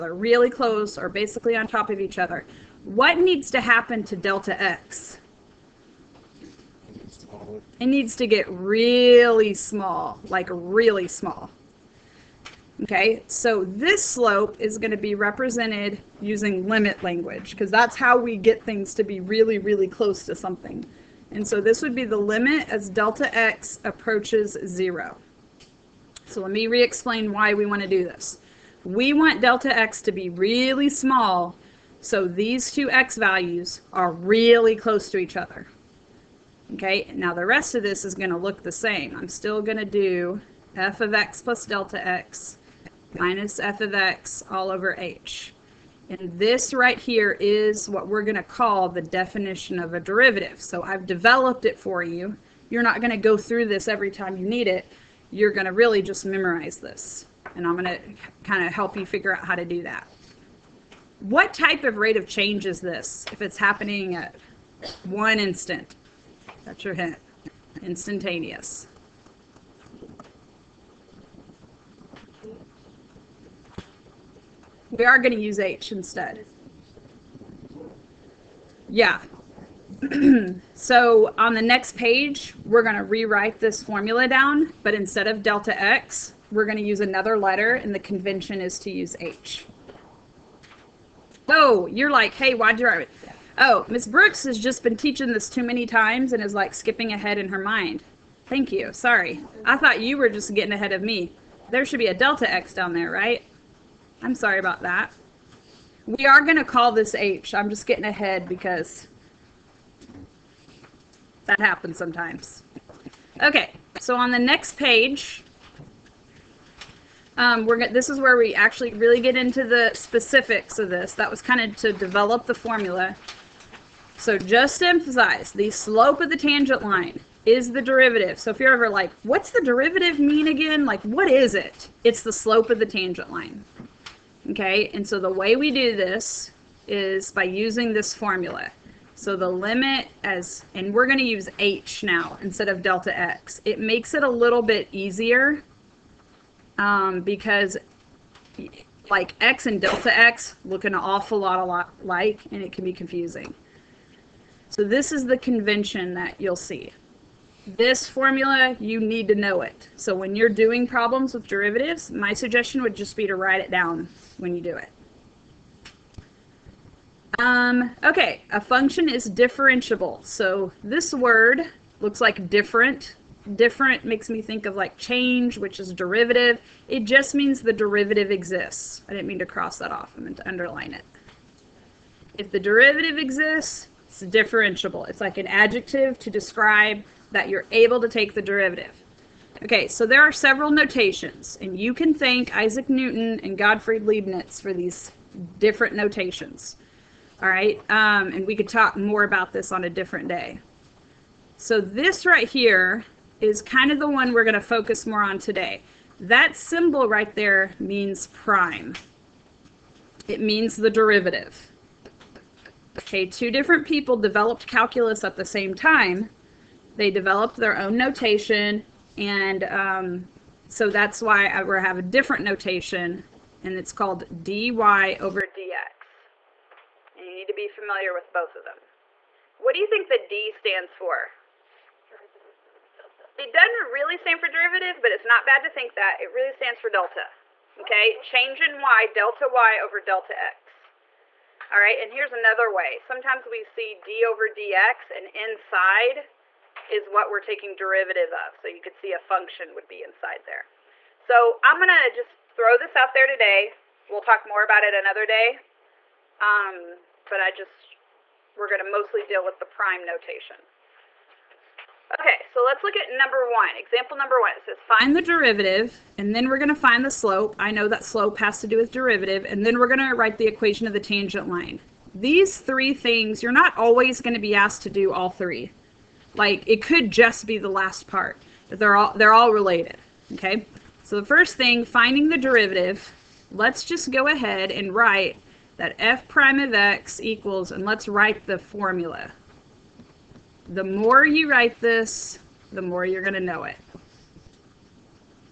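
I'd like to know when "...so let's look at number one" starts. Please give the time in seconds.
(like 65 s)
262 s.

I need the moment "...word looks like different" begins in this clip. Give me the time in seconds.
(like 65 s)
171 s.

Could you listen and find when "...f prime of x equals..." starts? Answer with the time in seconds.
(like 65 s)
285 s.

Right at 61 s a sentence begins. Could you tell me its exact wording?
What type of rate of change is this if it's happening at one instant?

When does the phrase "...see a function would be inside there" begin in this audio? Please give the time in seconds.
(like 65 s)
248 s.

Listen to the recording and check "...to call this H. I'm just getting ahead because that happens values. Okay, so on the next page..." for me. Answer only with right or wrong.
wrong.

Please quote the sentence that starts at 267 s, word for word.
I know that slope has to do with derivative, and then we're going to write the equation of the tangent line.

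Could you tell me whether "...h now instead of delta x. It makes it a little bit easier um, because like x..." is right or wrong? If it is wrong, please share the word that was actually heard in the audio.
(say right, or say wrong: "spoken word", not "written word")
right.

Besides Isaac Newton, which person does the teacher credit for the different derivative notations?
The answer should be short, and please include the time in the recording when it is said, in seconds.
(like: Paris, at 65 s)
Gottfried Leibniz, at 193 s.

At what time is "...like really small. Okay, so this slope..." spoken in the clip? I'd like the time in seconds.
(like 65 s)
10 s.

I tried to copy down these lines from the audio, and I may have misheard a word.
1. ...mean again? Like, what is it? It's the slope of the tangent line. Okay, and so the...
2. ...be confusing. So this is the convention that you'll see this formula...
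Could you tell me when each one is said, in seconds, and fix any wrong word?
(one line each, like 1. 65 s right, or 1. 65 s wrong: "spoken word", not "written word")
1. 130 s right
2. 152 s right.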